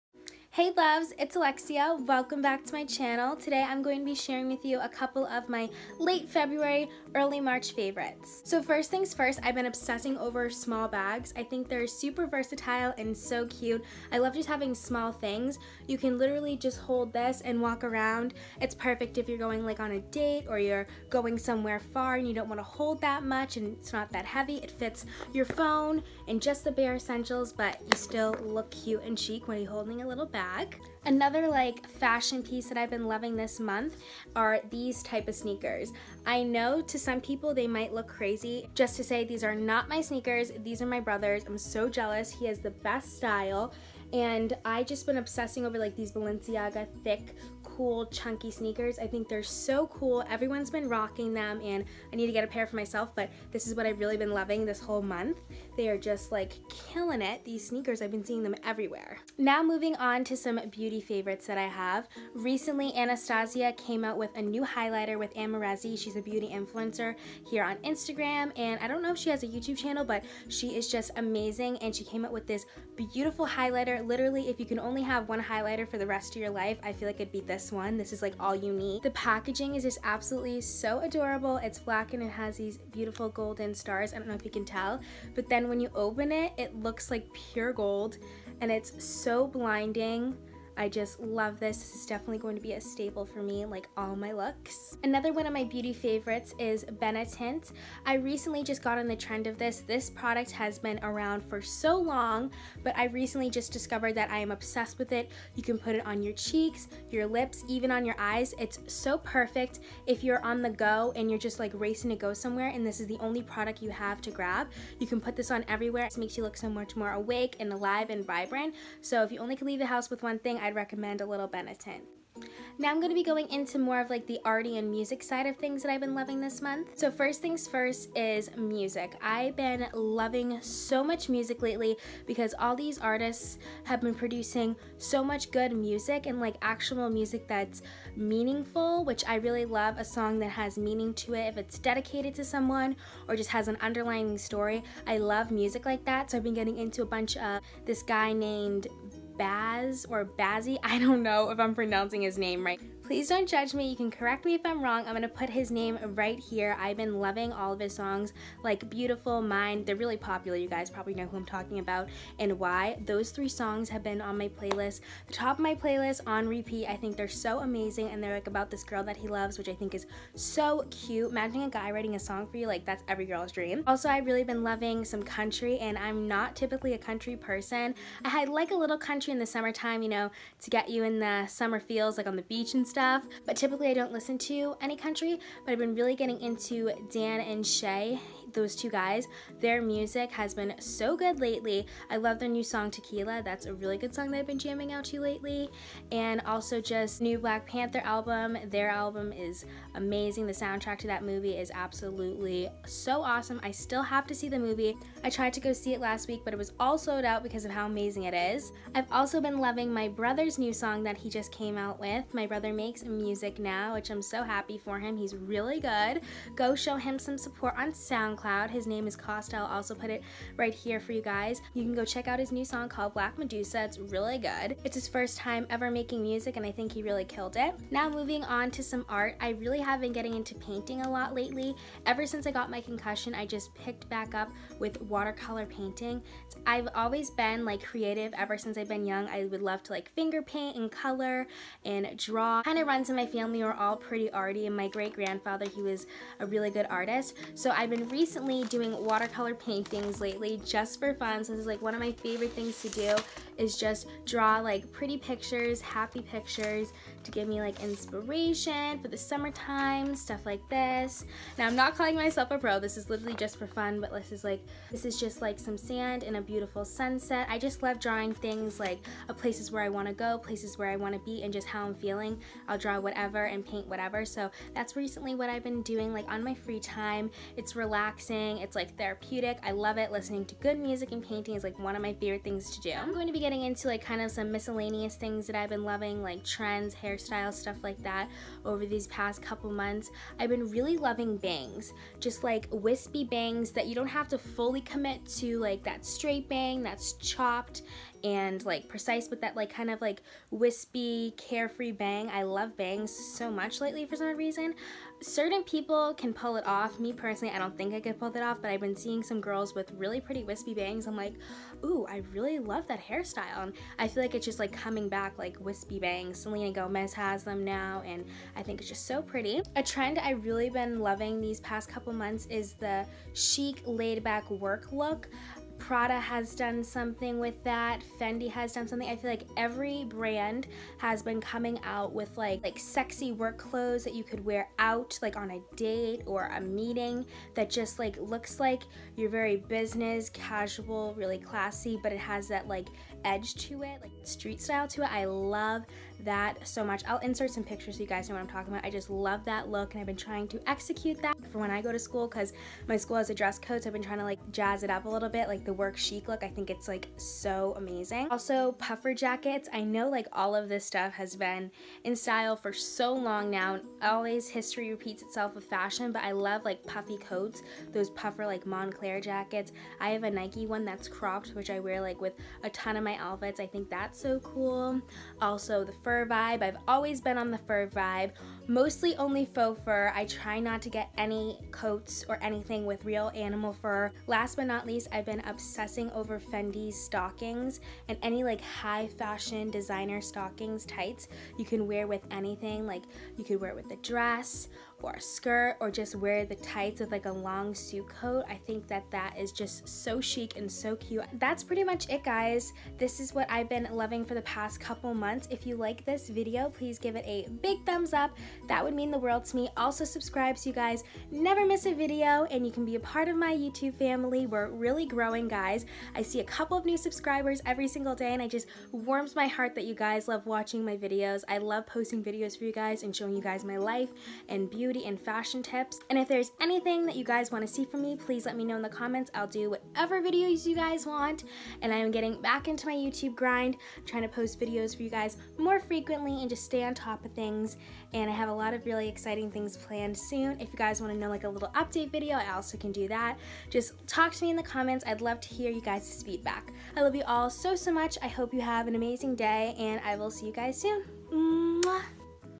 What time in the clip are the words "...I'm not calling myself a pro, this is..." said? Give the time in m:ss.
4:21.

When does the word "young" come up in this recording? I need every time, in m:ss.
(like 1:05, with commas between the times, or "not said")
3:59.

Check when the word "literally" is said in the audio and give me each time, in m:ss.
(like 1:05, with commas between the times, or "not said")
0:16, 1:14, 4:23.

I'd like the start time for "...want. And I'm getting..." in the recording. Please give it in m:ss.
7:11.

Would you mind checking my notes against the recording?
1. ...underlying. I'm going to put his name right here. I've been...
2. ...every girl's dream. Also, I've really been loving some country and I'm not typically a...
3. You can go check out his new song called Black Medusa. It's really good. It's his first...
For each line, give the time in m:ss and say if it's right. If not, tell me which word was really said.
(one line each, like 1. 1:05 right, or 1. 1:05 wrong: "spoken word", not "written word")
1. 2:34 wrong: "wrong", not "underlying"
2. 2:53 right
3. 3:41 right.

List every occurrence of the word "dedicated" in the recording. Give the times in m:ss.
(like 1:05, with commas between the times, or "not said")
2:21.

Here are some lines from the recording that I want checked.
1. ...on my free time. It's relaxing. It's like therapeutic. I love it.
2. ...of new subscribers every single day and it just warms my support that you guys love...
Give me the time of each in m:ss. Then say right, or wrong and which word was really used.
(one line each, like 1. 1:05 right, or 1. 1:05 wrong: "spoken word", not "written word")
1. 4:36 right
2. 6:56 wrong: "heart", not "support".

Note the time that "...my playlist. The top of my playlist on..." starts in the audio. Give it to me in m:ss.
2:44.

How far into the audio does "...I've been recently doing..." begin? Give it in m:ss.
4:07.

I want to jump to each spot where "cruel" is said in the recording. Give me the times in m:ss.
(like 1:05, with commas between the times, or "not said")
not said.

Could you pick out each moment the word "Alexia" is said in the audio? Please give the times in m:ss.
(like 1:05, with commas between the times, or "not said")
0:01.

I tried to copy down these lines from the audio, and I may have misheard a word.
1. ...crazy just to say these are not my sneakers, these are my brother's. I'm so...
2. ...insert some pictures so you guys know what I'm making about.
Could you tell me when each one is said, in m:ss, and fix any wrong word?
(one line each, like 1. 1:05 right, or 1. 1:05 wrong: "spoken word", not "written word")
1. 0:38 right
2. 5:47 wrong: "talking", not "making".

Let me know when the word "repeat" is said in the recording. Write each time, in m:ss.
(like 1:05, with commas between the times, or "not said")
2:46, 6:04.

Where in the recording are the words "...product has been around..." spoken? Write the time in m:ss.
1:40.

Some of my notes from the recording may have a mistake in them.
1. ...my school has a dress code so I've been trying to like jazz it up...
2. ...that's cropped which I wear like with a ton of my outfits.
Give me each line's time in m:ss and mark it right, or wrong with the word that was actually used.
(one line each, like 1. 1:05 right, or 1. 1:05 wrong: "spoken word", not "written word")
1. 5:52 right
2. 6:10 right.